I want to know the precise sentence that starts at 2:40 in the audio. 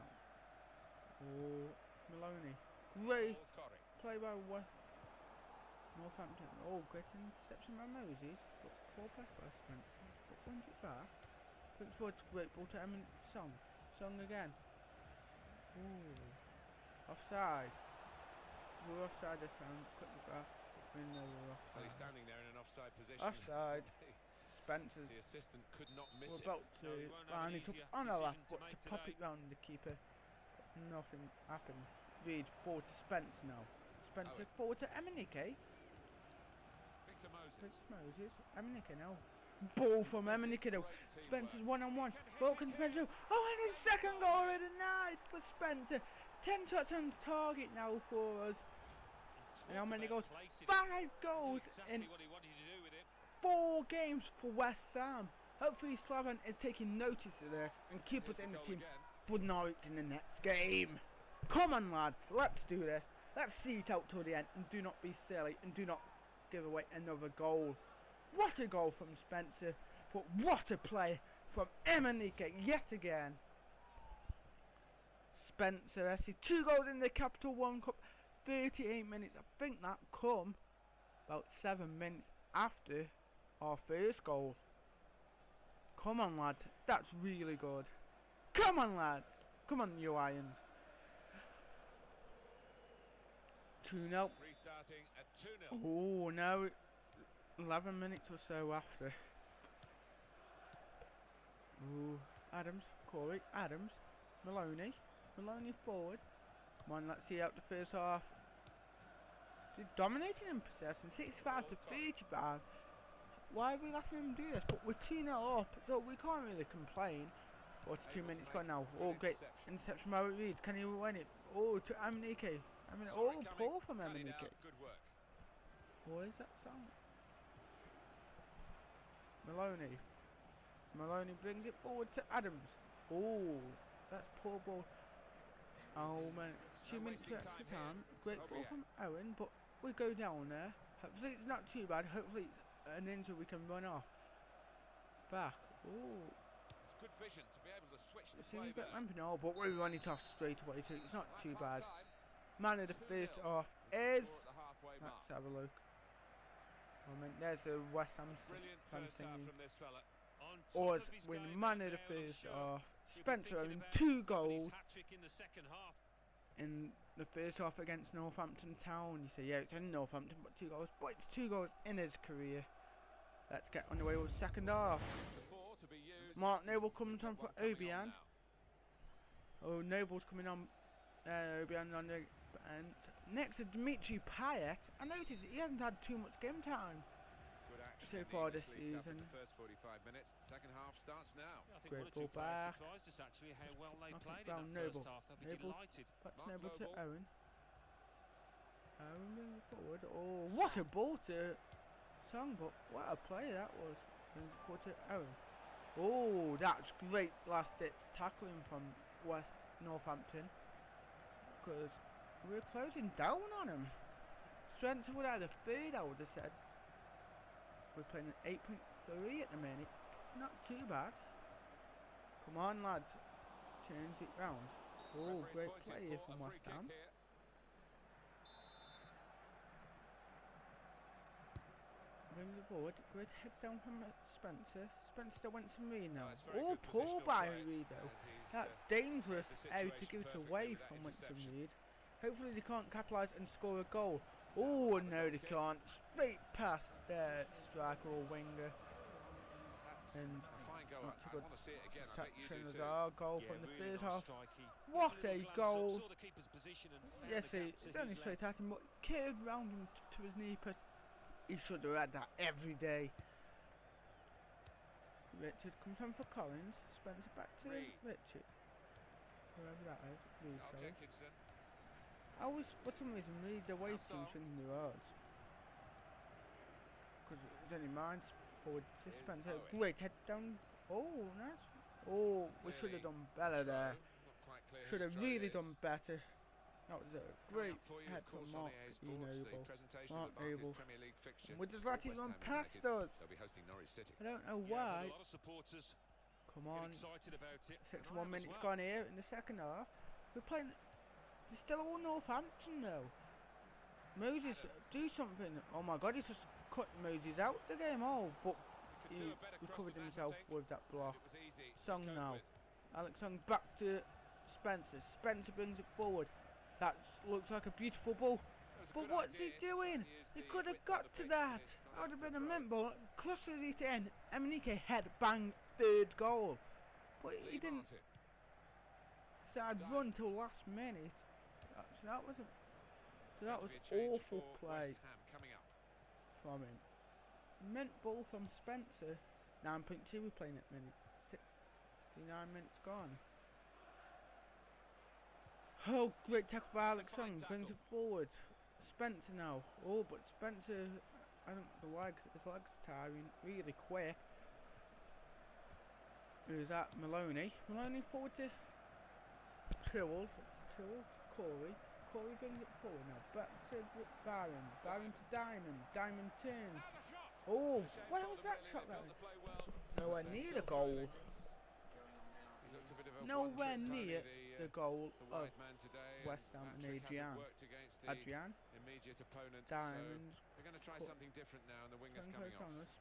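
Oz win man of the first half.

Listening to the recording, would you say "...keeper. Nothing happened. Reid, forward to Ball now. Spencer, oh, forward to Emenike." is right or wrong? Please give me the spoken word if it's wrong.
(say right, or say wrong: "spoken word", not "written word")
wrong: "Spence", not "Ball".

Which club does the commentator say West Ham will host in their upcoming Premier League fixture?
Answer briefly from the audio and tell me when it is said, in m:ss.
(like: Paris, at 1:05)
Norwich City, at 4:53.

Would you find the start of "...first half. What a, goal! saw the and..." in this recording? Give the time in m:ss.
4:13.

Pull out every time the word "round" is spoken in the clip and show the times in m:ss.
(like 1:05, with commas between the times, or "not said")
0:29, 3:44, 4:19.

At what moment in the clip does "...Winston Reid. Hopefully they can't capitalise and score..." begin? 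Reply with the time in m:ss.
4:01.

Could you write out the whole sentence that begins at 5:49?
Oh, but Spencer, I don't know why, his legs are tiring really quick.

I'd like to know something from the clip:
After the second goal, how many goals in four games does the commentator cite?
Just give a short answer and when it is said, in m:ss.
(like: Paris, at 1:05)
5, at 0:50.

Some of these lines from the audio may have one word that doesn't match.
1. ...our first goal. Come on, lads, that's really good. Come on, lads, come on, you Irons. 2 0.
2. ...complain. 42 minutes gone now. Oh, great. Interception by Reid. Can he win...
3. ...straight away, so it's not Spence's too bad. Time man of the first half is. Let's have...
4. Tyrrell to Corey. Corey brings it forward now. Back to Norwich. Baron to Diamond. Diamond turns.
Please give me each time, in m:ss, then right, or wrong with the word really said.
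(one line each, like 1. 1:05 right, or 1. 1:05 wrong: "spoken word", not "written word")
1. 1:23 right
2. 1:56 right
3. 2:30 wrong: "That", not "Spence"
4. 6:00 wrong: "Baron", not "Norwich".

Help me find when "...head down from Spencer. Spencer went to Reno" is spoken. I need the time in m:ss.
3:53.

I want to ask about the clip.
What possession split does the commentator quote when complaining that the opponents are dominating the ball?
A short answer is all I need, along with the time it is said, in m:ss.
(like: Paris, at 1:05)
65 to 35, at 1:51.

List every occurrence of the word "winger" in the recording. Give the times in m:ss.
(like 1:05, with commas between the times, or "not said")
4:08, 6:21.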